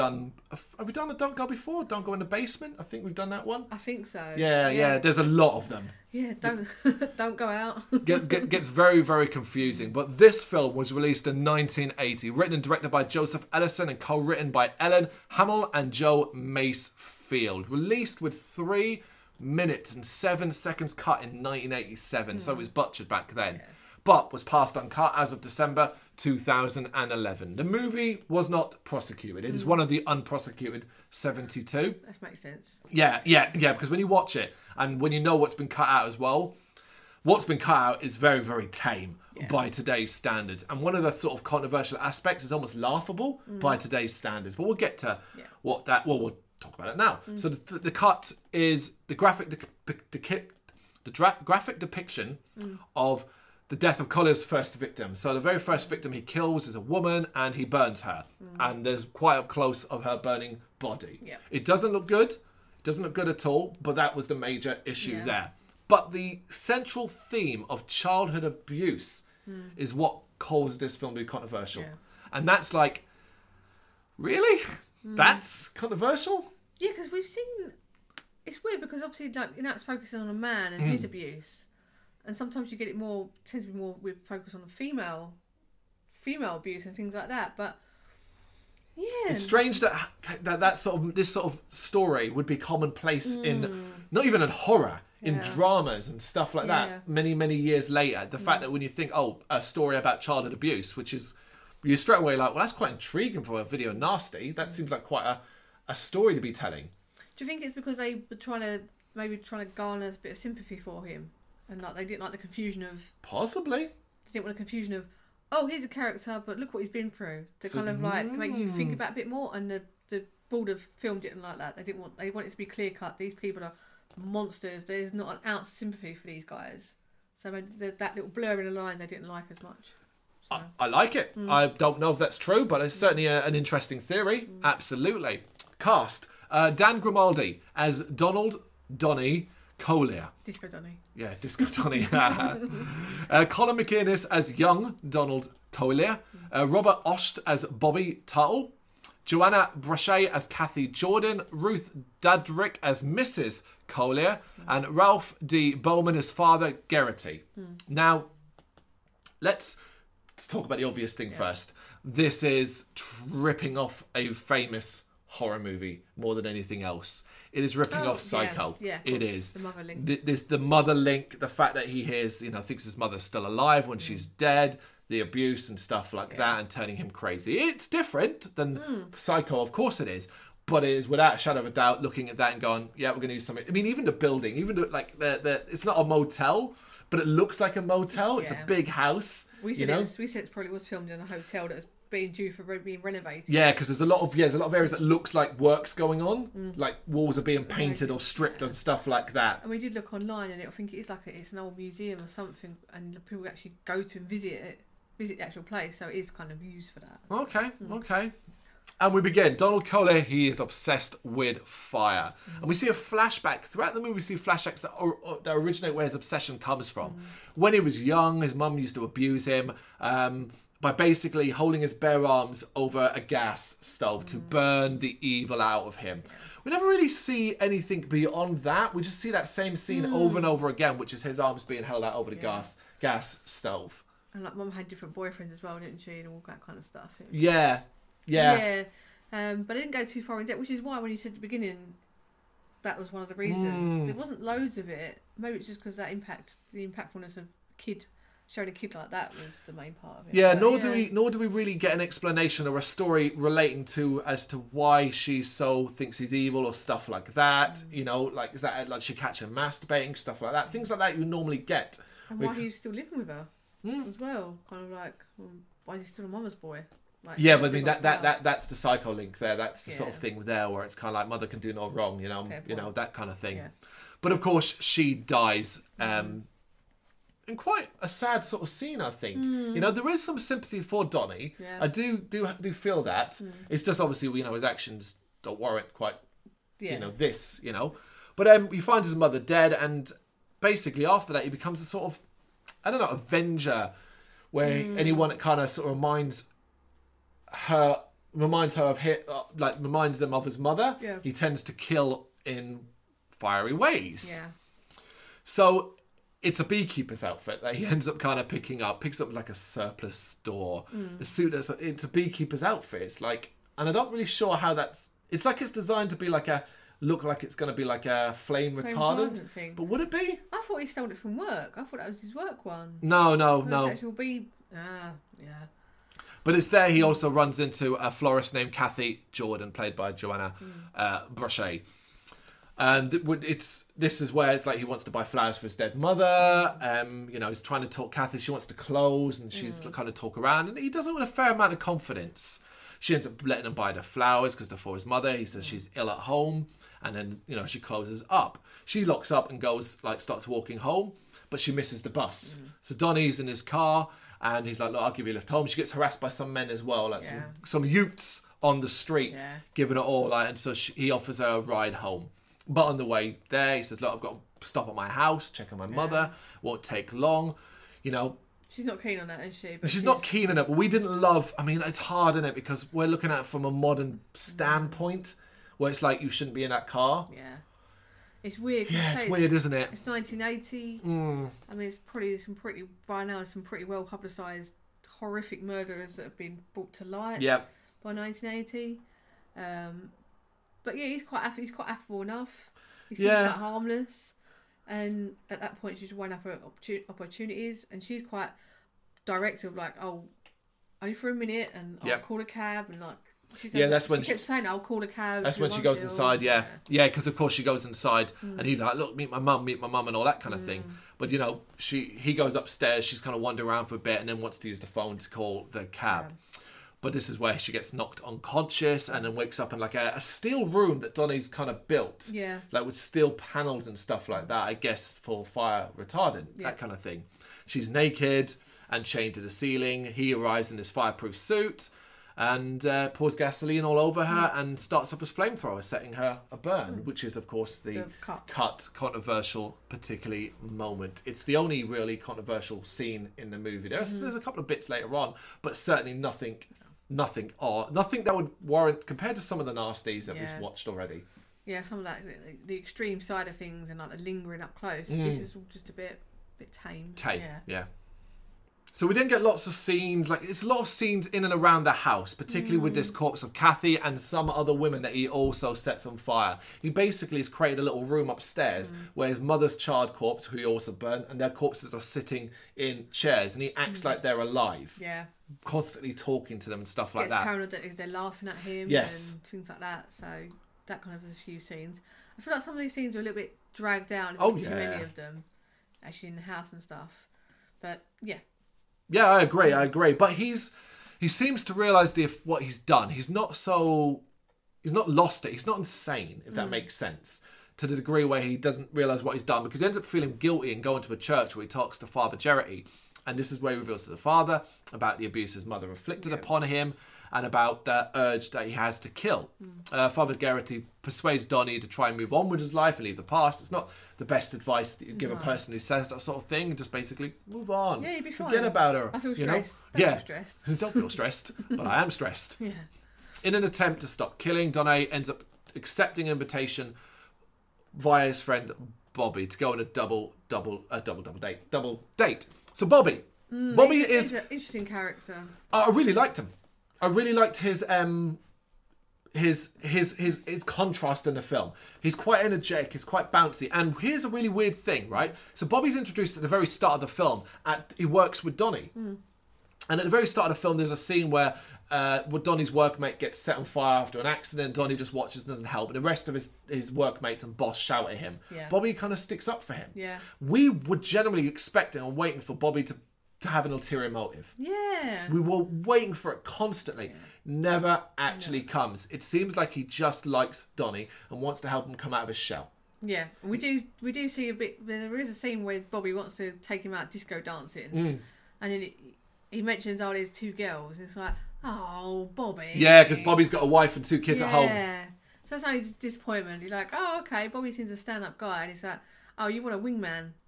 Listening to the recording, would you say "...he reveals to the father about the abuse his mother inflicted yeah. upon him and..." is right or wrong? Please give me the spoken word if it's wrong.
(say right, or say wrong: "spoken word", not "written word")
right.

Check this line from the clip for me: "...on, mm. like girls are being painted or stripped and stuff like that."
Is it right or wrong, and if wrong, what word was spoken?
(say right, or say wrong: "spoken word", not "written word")
wrong: "walls", not "girls".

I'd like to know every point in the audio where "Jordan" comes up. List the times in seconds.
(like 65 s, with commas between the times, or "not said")
150 s, 329 s.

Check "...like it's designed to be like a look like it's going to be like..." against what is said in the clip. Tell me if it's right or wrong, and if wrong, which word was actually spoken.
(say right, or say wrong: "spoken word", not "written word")
right.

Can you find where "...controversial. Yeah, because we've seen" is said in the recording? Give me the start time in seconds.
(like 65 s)
75 s.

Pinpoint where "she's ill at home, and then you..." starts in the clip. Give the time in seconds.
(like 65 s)
345 s.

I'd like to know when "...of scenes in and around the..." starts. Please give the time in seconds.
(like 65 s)
460 s.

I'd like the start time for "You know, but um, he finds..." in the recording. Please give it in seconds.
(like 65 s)
287 s.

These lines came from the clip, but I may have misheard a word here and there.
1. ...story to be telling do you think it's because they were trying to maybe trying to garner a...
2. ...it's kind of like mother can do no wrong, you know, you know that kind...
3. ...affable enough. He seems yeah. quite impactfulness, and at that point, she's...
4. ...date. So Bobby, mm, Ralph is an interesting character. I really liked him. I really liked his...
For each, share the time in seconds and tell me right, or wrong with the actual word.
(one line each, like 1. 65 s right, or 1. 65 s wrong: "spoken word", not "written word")
1. 105 s right
2. 270 s right
3. 391 s wrong: "harmless", not "impactfulness"
4. 532 s wrong: "Bobby", not "Ralph".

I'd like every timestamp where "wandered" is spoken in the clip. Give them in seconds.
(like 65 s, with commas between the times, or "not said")
413 s.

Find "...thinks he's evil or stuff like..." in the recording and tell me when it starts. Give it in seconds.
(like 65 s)
255 s.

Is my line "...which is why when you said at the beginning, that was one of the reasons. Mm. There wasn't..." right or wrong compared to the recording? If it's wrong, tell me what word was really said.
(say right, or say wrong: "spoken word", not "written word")
right.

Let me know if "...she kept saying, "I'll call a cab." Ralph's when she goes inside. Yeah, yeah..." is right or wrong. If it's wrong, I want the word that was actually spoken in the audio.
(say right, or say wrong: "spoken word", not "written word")
wrong: "That", not "Ralph".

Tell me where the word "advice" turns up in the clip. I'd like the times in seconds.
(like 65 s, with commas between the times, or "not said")
514 s.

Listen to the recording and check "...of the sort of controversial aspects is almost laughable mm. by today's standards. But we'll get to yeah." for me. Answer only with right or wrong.
right.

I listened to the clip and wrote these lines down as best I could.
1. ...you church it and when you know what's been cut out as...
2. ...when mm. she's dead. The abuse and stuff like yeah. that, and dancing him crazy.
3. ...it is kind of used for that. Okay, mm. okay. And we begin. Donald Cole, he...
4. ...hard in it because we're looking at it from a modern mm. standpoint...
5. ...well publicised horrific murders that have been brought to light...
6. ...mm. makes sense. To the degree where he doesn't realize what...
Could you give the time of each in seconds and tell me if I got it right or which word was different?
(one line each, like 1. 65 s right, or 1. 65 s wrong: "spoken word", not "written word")
1. 33 s wrong: "watch", not "church"
2. 173 s wrong: "turning", not "dancing"
3. 206 s right
4. 371 s right
5. 383 s right
6. 496 s right.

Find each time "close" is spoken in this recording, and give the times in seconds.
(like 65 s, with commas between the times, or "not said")
59 s, 338 s, 347 s, 454 s.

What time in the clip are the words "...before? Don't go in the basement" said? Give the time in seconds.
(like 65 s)
1 s.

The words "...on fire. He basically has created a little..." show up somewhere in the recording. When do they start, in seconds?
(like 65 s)
466 s.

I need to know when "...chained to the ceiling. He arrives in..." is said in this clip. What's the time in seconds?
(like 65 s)
429 s.